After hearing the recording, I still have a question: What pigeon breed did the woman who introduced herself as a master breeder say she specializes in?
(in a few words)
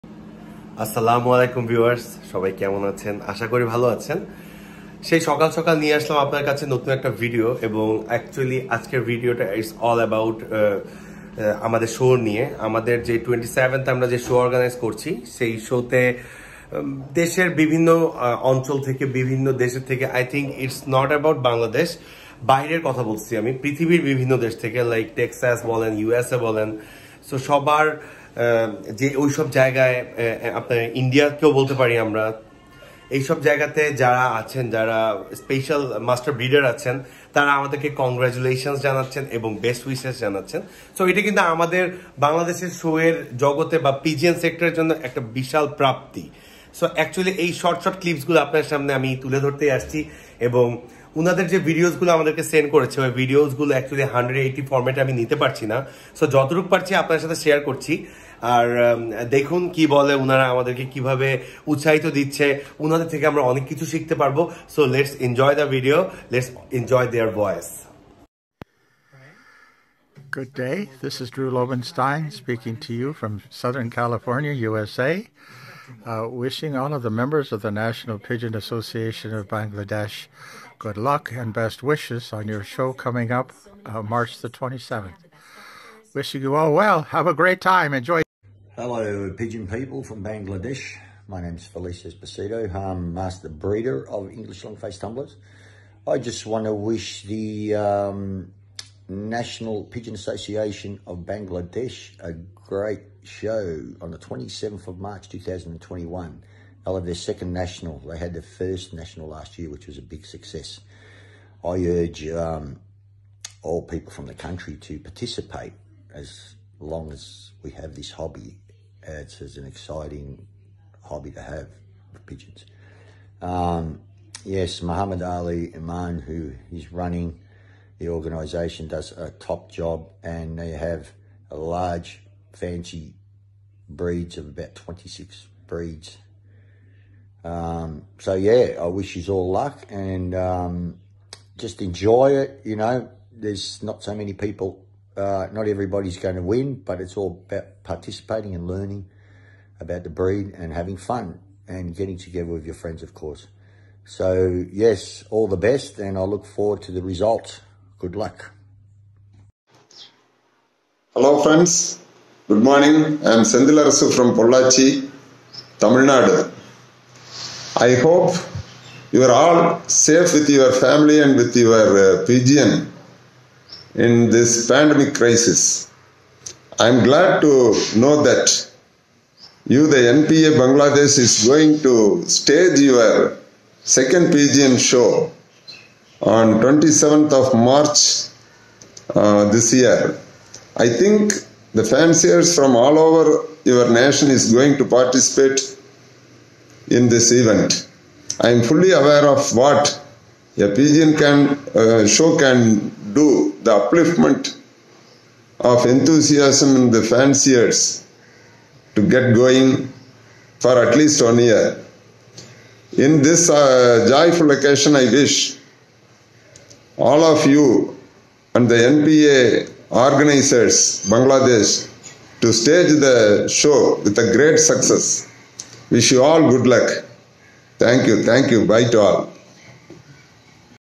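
English Long Face tumblers.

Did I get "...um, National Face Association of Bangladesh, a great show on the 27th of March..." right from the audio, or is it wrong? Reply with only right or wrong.
wrong.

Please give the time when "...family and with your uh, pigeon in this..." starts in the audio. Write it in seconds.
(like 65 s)
170 s.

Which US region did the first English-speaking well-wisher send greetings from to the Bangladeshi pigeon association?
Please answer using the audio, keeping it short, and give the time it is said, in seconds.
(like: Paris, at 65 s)
Southern California, at 73 s.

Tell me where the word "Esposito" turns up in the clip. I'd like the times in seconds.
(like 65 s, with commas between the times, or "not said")
92 s.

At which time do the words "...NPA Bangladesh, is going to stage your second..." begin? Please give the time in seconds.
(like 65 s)
180 s.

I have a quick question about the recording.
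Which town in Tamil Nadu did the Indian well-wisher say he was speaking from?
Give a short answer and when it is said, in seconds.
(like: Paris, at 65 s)
Pollachi, at 164 s.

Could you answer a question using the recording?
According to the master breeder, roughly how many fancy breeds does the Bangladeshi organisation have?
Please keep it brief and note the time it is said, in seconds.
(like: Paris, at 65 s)
26, at 134 s.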